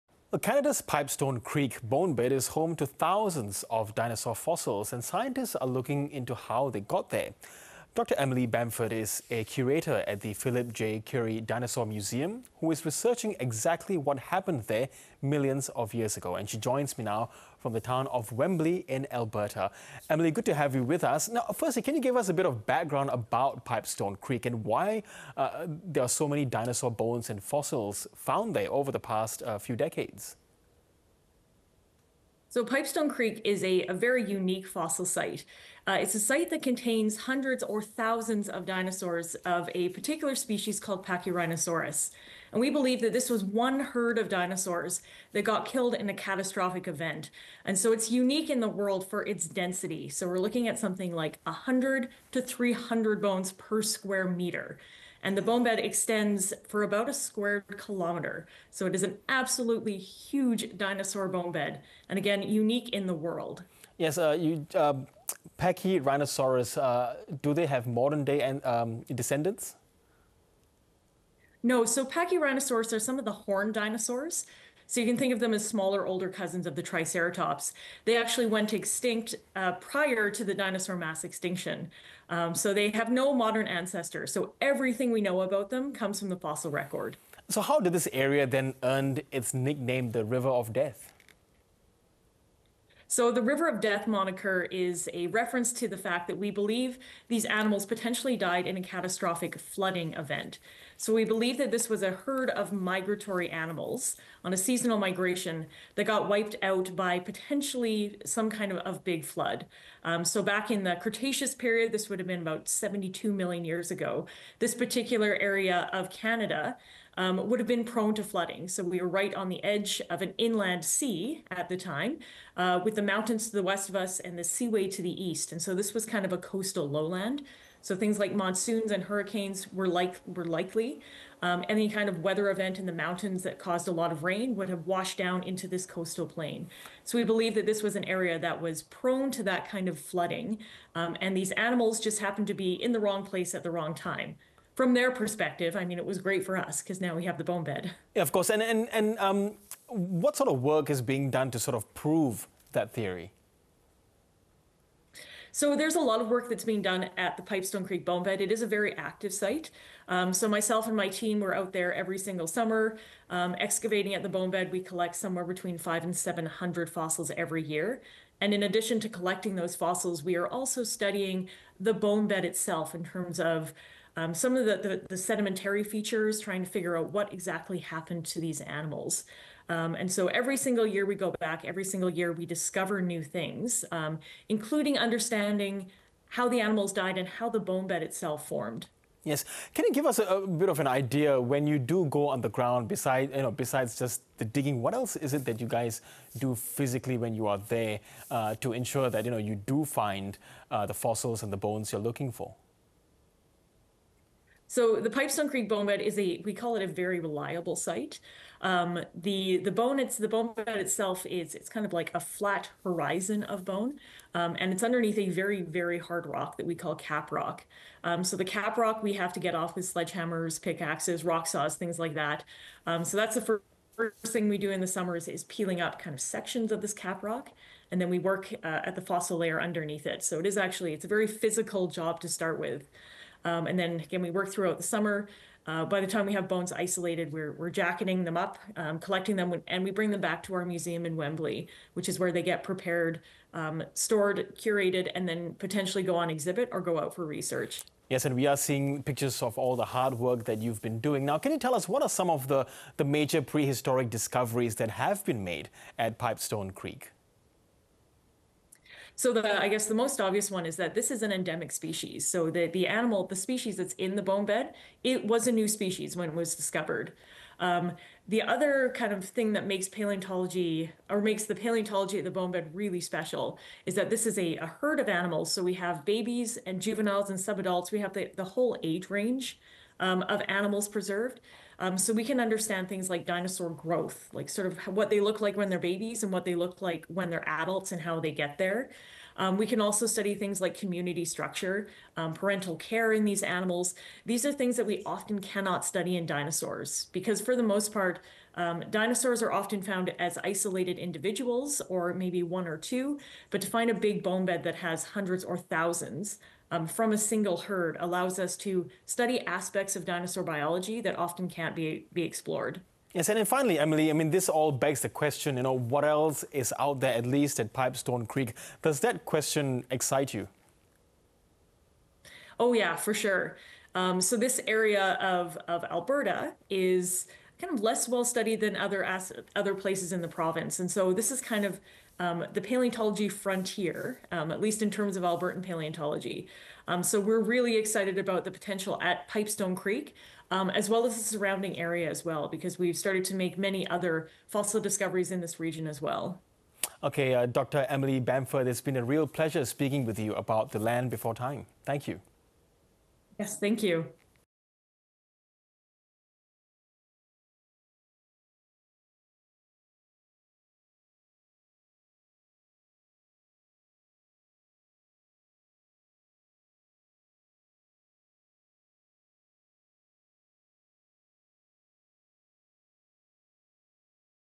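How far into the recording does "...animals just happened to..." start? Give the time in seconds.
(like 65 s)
141 s.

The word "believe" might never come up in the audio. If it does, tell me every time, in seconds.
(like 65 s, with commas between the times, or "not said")
42 s, 96 s, 101 s, 137 s.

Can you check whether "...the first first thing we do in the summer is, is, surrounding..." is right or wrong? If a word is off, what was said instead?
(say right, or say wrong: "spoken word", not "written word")
wrong: "peeling", not "surrounding".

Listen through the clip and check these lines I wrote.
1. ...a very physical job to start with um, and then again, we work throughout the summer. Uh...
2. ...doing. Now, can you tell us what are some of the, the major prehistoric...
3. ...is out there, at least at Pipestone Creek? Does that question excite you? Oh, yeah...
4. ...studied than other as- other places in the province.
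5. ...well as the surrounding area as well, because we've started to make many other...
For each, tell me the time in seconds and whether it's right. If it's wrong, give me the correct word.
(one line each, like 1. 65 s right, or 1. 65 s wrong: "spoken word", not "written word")
1. 231 s right
2. 250 s right
3. 316 s right
4. 328 s right
5. 340 s right.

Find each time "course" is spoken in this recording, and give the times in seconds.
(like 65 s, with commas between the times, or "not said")
148 s.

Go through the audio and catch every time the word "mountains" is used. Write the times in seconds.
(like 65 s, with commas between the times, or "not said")
123 s, 132 s.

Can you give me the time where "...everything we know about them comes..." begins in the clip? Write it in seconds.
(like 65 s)
84 s.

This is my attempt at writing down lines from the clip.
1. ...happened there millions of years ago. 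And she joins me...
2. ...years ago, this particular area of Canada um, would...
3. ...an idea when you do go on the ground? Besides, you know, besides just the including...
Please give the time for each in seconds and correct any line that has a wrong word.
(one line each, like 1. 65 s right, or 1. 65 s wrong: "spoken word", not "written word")
1. 14 s right
2. 113 s right
3. 190 s wrong: "digging", not "including".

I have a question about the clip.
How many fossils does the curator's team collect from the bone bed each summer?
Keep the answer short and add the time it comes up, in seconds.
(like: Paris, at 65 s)
500 to 700, at 165 s.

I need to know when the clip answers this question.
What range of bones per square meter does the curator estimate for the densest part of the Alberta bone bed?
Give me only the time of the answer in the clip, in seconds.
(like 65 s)
51 s.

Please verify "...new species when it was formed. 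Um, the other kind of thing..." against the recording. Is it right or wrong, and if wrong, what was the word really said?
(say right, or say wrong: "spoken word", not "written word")
wrong: "discovered", not "formed".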